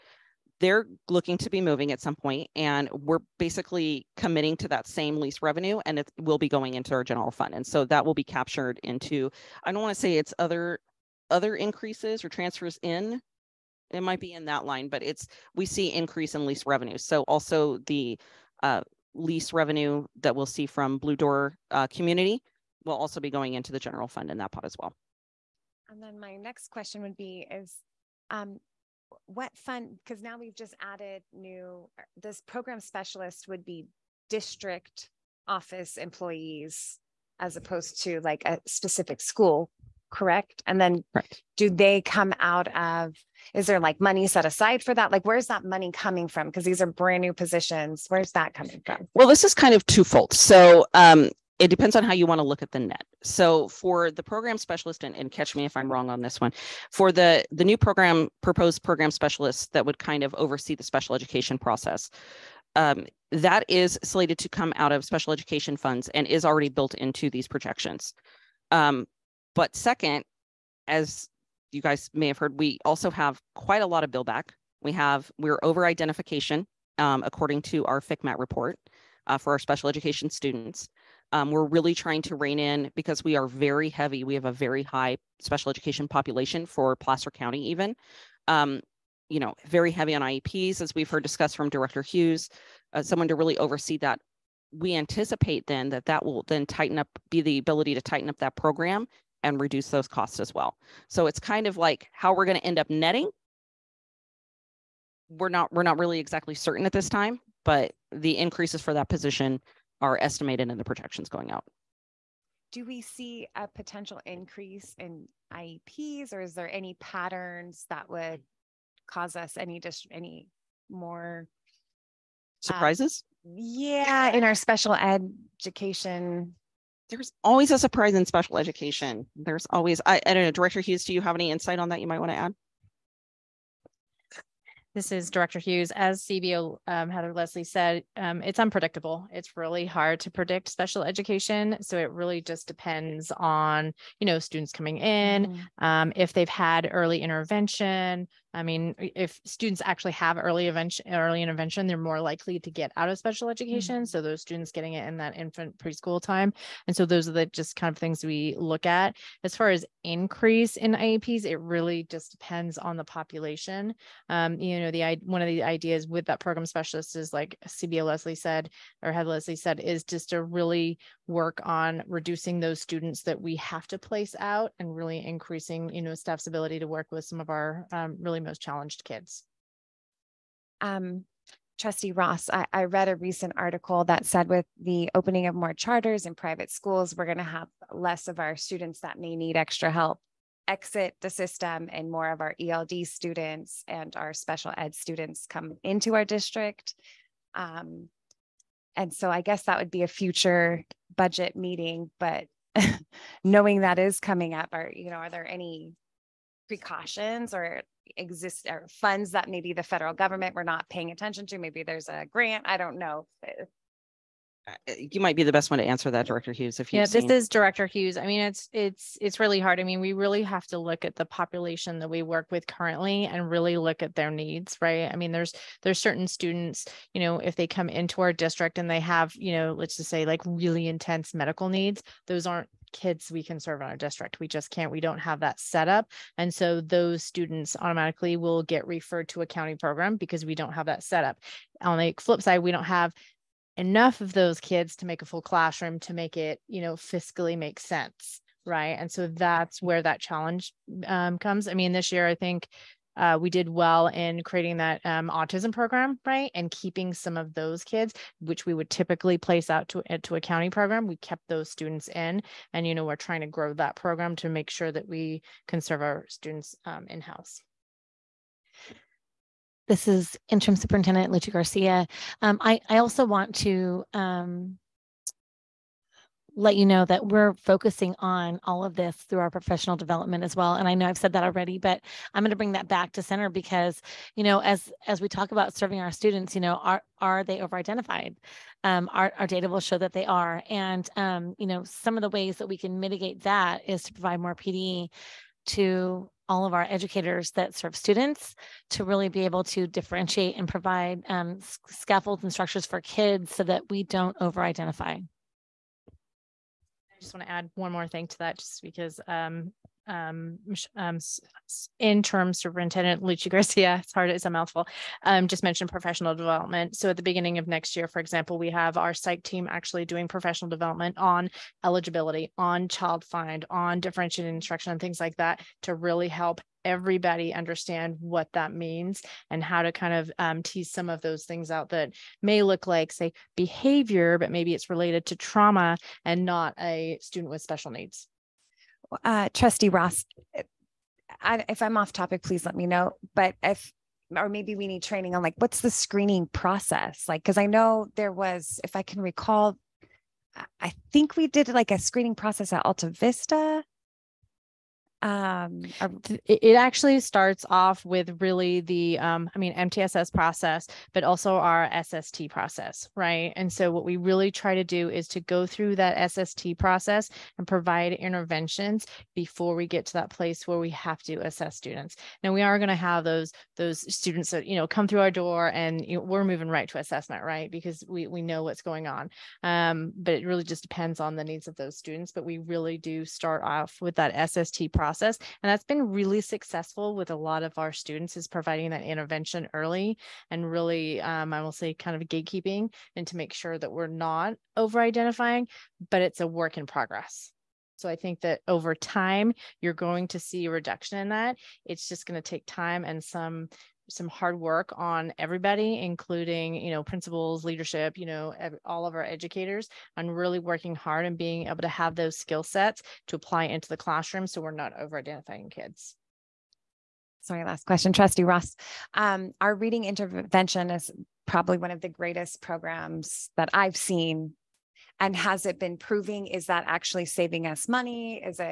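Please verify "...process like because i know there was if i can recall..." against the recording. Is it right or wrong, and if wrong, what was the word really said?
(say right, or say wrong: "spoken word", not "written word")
right.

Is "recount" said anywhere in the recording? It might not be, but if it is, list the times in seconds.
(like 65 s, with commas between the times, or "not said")
not said.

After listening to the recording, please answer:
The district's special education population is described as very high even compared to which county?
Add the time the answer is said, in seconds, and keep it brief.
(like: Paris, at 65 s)
Placer County, at 86 s.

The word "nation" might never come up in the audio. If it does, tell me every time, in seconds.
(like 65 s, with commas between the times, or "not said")
not said.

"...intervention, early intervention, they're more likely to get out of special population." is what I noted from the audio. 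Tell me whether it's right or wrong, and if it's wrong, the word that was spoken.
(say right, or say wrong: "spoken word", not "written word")
wrong: "education", not "population".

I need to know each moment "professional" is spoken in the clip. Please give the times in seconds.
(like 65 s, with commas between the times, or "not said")
279 s, 315 s, 320 s.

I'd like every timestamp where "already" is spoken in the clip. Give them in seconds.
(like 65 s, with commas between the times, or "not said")
66 s, 281 s.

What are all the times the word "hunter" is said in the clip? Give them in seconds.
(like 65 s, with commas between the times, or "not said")
not said.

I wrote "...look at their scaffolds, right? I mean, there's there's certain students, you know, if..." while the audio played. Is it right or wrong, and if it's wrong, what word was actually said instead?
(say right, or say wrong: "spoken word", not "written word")
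wrong: "needs", not "scaffolds".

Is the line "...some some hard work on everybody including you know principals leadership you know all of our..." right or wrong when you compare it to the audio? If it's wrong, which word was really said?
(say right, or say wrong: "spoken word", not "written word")
right.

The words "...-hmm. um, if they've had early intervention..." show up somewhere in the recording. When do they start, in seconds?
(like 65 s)
145 s.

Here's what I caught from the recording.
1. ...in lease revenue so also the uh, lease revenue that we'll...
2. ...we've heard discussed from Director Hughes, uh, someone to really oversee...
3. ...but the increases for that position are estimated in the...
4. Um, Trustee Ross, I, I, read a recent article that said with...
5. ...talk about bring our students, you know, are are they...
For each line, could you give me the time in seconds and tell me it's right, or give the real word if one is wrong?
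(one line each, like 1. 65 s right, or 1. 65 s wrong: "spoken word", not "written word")
1. 16 s right
2. 90 s right
3. 107 s right
4. 180 s right
5. 285 s wrong: "serving", not "bring".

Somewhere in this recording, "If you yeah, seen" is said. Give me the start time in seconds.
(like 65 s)
216 s.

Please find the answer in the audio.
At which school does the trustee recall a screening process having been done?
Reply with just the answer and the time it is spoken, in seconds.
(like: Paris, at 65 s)
Alta Vista, at 352 s.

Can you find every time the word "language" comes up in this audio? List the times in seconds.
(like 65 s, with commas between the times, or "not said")
not said.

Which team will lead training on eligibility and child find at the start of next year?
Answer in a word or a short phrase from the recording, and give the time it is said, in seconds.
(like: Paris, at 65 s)
psych team, at 319 s.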